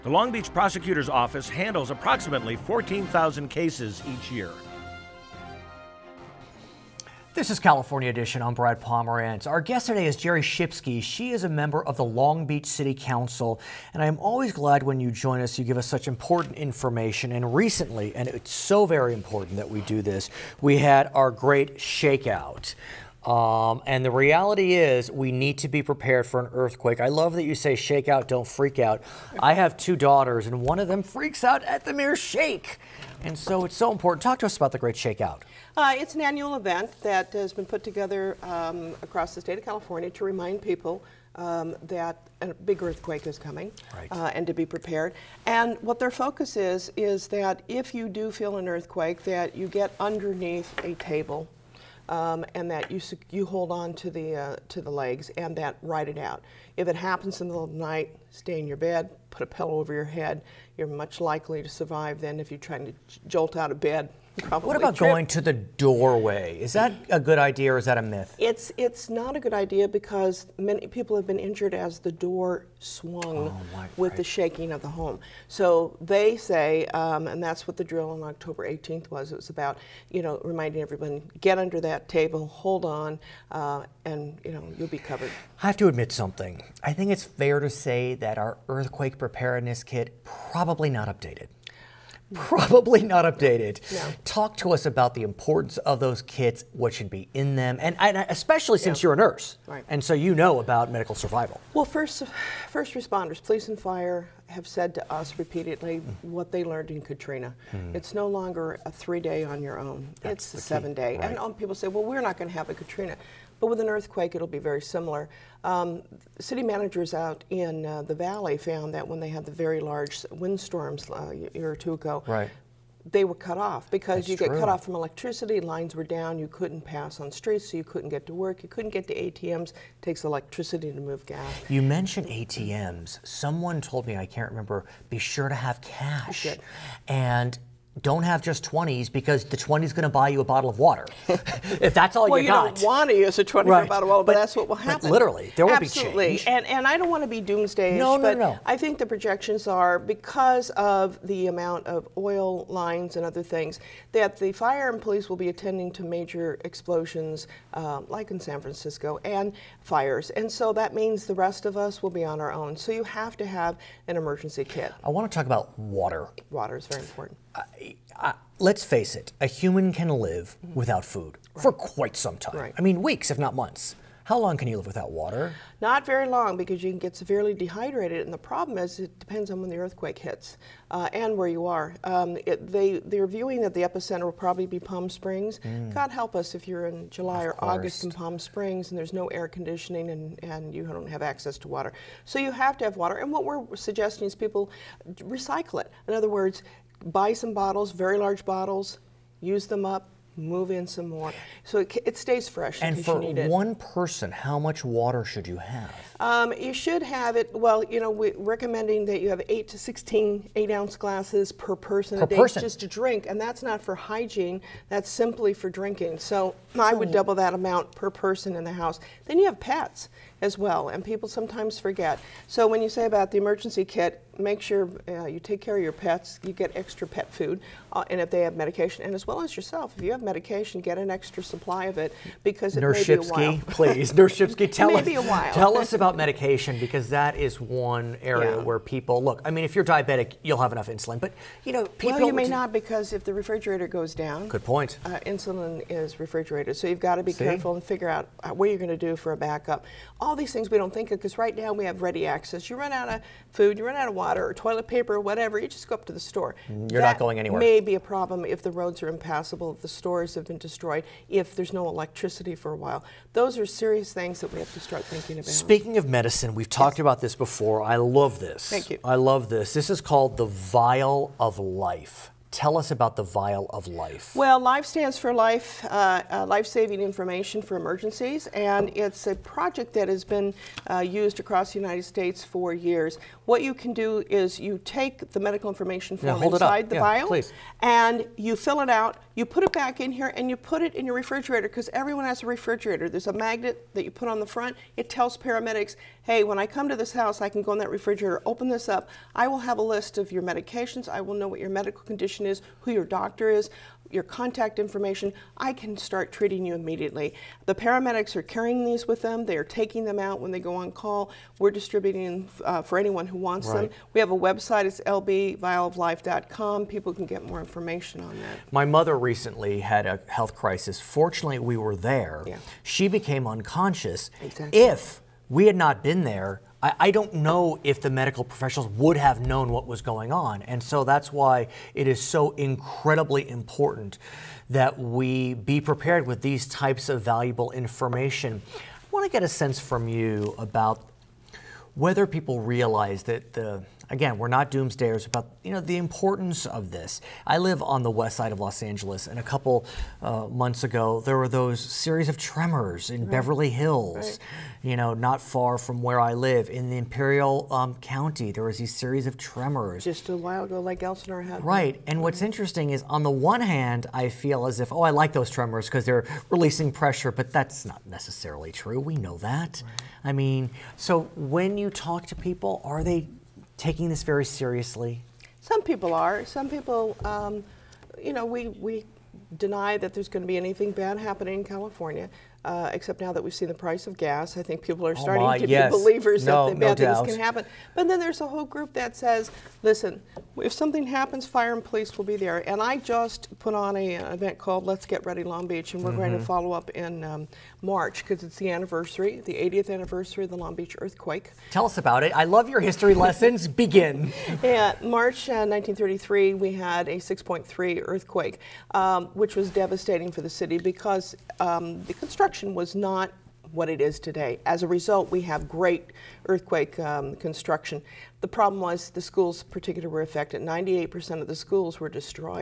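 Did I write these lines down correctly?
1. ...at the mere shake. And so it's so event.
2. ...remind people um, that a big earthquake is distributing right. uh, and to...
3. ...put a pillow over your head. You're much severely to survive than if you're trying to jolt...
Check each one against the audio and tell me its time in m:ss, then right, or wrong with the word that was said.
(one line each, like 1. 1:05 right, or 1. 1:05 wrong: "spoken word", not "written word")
1. 0:31 wrong: "important", not "event"
2. 0:40 wrong: "coming", not "distributing"
3. 0:59 wrong: "likely", not "severely".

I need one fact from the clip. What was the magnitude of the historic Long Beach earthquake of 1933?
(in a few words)
6.3.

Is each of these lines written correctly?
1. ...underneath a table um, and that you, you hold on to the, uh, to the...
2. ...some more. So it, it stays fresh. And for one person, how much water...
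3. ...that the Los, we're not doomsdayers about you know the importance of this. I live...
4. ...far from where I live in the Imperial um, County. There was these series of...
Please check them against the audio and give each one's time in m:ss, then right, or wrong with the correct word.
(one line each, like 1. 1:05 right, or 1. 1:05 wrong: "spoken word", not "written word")
1. 0:49 right
2. 3:20 right
3. 5:43 wrong: "Again", not "Los"
4. 5:55 right.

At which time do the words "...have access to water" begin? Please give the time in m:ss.
3:11.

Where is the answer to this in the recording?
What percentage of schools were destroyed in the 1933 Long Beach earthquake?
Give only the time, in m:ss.
7:00.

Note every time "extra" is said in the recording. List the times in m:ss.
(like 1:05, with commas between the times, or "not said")
3:46, 3:51.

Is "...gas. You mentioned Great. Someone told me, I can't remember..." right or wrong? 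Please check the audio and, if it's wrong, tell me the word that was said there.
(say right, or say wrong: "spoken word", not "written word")
wrong: "ATMs", not "Great".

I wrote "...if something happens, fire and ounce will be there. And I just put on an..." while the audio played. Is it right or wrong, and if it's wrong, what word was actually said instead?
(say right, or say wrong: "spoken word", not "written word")
wrong: "police", not "ounce".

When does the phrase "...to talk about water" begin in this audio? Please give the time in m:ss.
2:45.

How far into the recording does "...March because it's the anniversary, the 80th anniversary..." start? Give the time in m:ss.
6:37.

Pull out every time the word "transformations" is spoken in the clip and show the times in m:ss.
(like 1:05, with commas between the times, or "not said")
not said.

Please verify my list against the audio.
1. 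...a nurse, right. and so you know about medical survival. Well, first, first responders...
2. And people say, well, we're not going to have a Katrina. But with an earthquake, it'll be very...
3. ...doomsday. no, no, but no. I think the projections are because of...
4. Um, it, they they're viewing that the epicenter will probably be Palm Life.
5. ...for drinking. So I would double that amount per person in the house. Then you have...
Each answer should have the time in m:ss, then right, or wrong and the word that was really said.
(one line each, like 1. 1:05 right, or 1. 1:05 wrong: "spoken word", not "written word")
1. 1:39 right
2. 1:51 right
3. 2:27 right
4. 3:02 wrong: "Springs", not "Life"
5. 3:35 right.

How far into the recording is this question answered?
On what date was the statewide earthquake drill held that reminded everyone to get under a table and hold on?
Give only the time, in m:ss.
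1:18.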